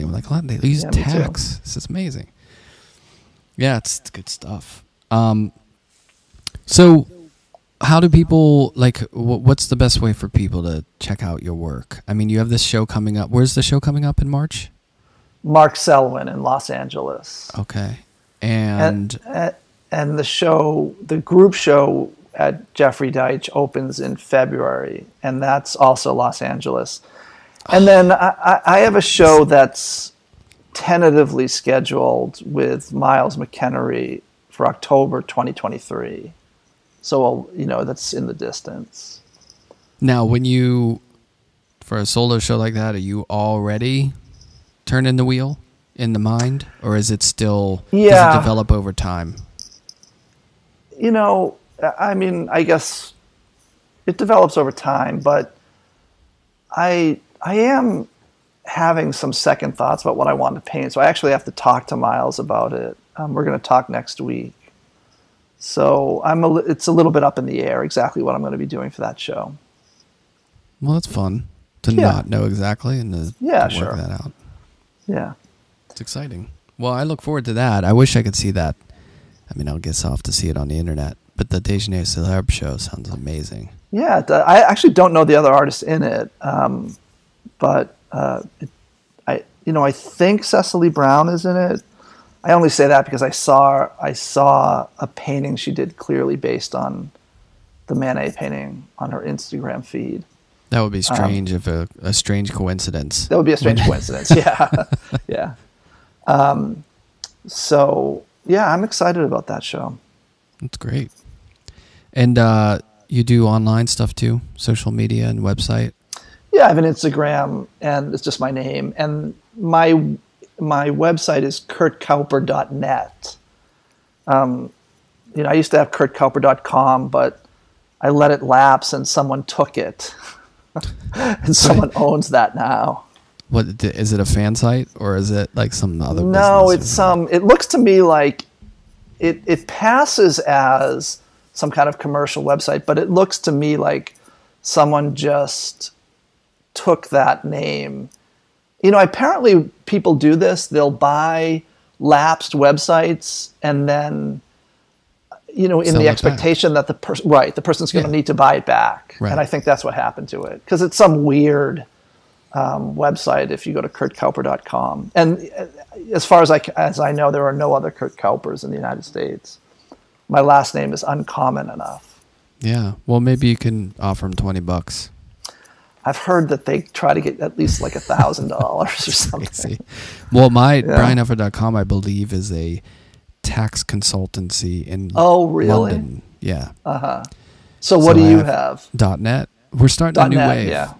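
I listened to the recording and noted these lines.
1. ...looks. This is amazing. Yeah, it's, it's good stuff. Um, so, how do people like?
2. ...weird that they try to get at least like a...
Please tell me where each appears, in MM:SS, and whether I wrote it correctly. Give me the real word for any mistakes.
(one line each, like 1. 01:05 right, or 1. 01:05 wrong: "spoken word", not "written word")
1. 00:01 wrong: "tacks", not "looks"
2. 02:56 wrong: "heard", not "weird".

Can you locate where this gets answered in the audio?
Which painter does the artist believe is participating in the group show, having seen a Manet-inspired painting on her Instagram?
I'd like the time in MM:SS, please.
01:30.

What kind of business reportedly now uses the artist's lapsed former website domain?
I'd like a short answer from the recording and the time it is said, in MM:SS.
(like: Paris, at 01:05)
tax consultancy, at 03:03.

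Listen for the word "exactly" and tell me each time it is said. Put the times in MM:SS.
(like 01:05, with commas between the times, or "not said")
01:07, 01:12.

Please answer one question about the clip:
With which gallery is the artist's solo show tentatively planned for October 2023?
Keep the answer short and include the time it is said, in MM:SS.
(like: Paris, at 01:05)
Miles McEnery, at 00:32.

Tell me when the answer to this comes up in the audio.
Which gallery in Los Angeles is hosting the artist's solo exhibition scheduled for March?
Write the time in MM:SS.
00:15.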